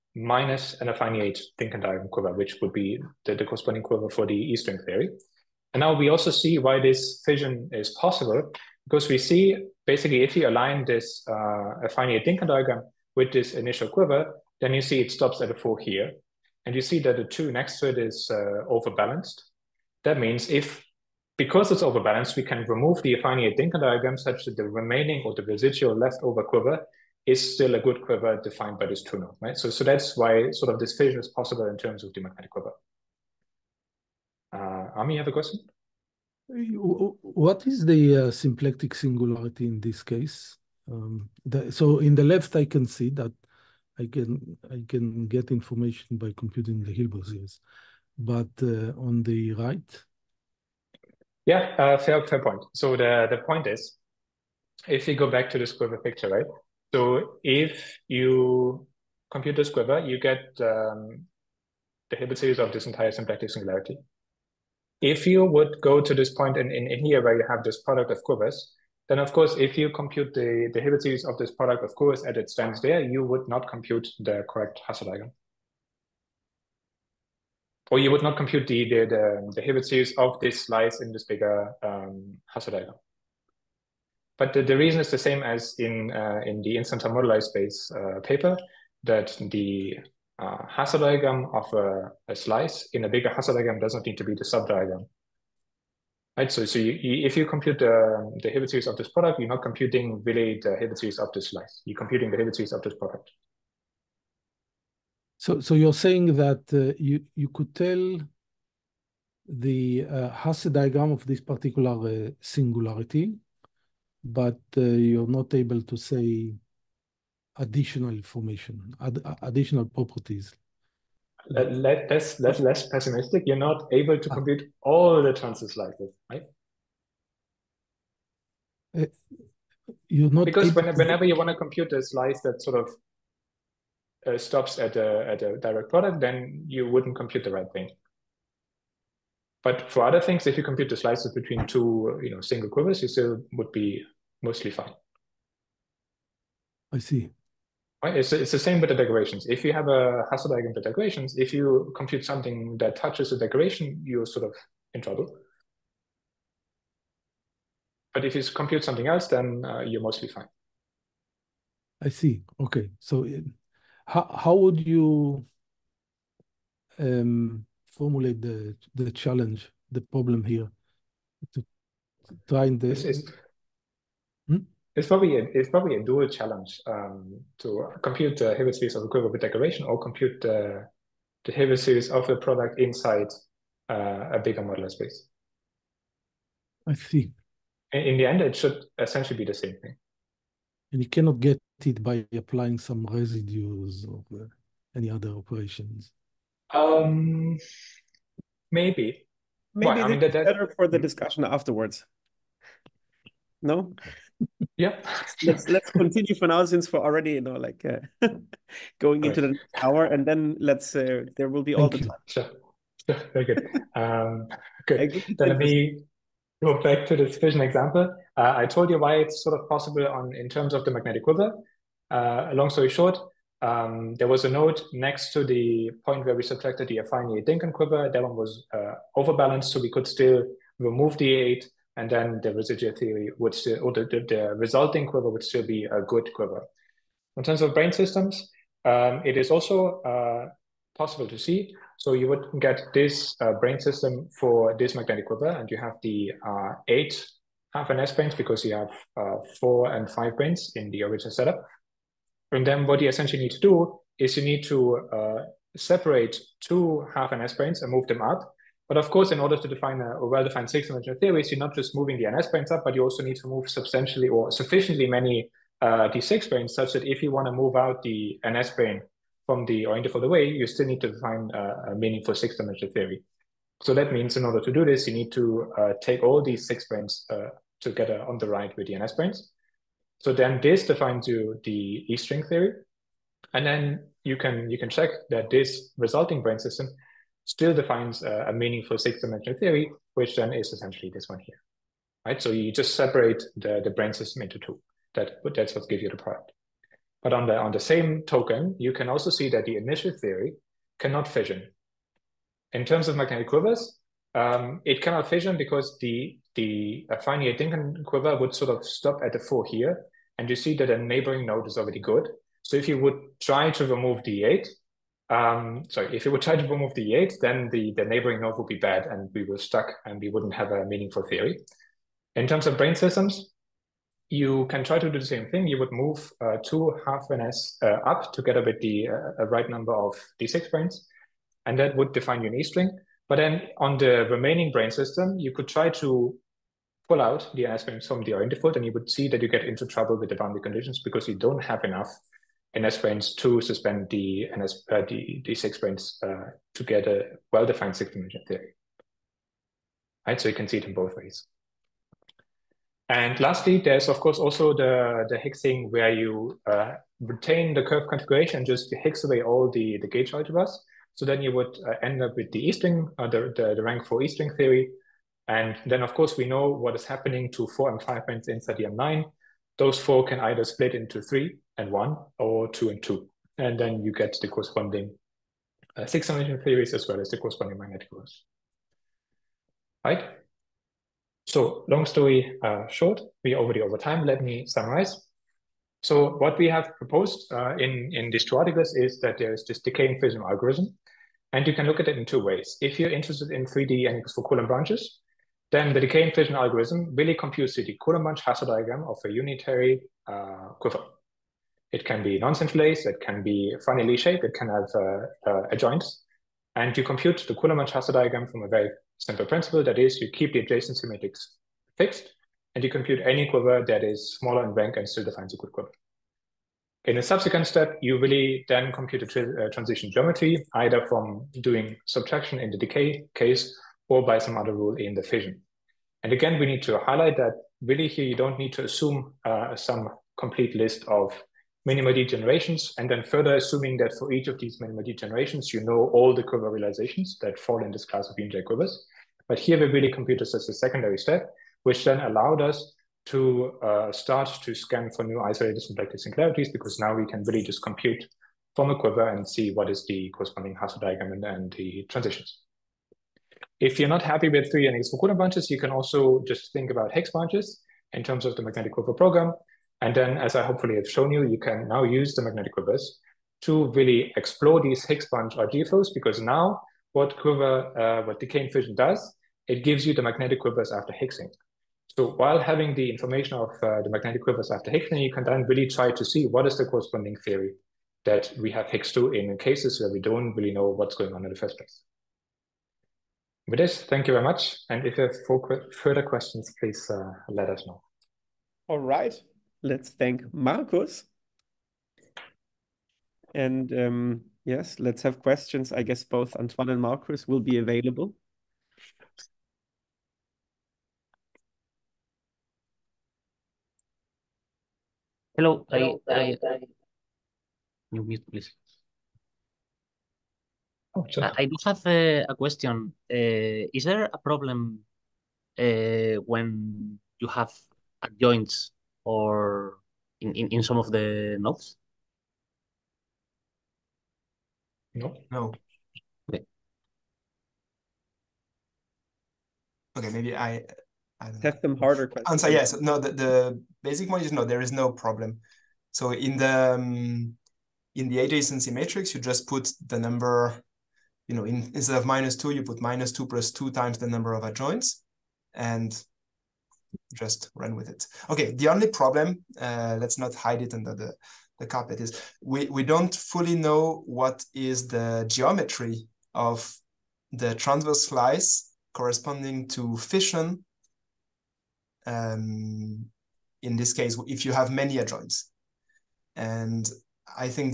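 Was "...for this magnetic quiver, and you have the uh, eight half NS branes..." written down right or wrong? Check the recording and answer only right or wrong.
right.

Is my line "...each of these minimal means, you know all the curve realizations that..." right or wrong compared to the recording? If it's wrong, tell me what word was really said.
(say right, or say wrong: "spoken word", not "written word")
wrong: "degenerations", not "means".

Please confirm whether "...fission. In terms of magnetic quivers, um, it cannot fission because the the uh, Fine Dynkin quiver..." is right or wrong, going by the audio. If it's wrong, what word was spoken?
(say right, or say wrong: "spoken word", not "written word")
right.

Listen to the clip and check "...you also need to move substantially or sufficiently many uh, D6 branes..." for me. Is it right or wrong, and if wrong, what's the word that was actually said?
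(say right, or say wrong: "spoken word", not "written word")
right.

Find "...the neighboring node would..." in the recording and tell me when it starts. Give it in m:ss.
5:17.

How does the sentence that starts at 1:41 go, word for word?
You're computing the Hilbert series of this product.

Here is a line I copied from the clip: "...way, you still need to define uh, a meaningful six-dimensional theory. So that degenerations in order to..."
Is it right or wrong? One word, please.
wrong.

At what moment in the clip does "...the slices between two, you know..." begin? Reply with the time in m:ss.
2:20.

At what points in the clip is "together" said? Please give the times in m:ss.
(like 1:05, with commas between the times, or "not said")
4:37, 5:28.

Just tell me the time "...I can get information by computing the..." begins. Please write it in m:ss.
0:44.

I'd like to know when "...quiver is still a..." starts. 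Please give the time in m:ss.
0:26.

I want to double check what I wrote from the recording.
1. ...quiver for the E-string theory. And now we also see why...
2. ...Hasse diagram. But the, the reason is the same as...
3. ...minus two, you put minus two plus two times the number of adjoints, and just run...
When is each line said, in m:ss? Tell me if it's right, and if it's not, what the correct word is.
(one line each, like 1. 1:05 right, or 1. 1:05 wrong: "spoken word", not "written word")
1. 0:03 right
2. 1:22 right
3. 9:02 right.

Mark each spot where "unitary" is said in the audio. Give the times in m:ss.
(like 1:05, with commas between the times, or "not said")
6:39.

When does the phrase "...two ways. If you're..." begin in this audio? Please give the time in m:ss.
6:32.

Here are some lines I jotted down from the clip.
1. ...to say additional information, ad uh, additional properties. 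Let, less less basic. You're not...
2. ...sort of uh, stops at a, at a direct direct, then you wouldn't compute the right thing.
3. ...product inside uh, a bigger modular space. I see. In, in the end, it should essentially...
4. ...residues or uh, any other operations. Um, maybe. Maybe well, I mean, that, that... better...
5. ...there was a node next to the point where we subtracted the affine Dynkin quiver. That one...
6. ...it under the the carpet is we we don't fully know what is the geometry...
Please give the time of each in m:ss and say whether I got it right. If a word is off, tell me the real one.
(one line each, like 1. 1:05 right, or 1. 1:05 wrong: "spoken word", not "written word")
1. 1:55 wrong: "pessimistic", not "basic"
2. 2:12 wrong: "product", not "direct"
3. 3:02 right
4. 3:13 right
5. 3:44 right
6. 9:10 right.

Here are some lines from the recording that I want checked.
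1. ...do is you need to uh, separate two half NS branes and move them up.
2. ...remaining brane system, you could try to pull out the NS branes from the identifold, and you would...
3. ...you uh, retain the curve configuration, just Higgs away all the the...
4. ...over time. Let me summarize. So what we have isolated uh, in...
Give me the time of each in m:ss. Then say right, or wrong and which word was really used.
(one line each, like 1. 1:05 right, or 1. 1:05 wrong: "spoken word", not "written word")
1. 4:13 right
2. 5:34 right
3. 5:56 right
4. 6:23 wrong: "proposed", not "isolated".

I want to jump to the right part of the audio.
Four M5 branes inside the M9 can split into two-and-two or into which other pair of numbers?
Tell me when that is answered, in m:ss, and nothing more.
6:11.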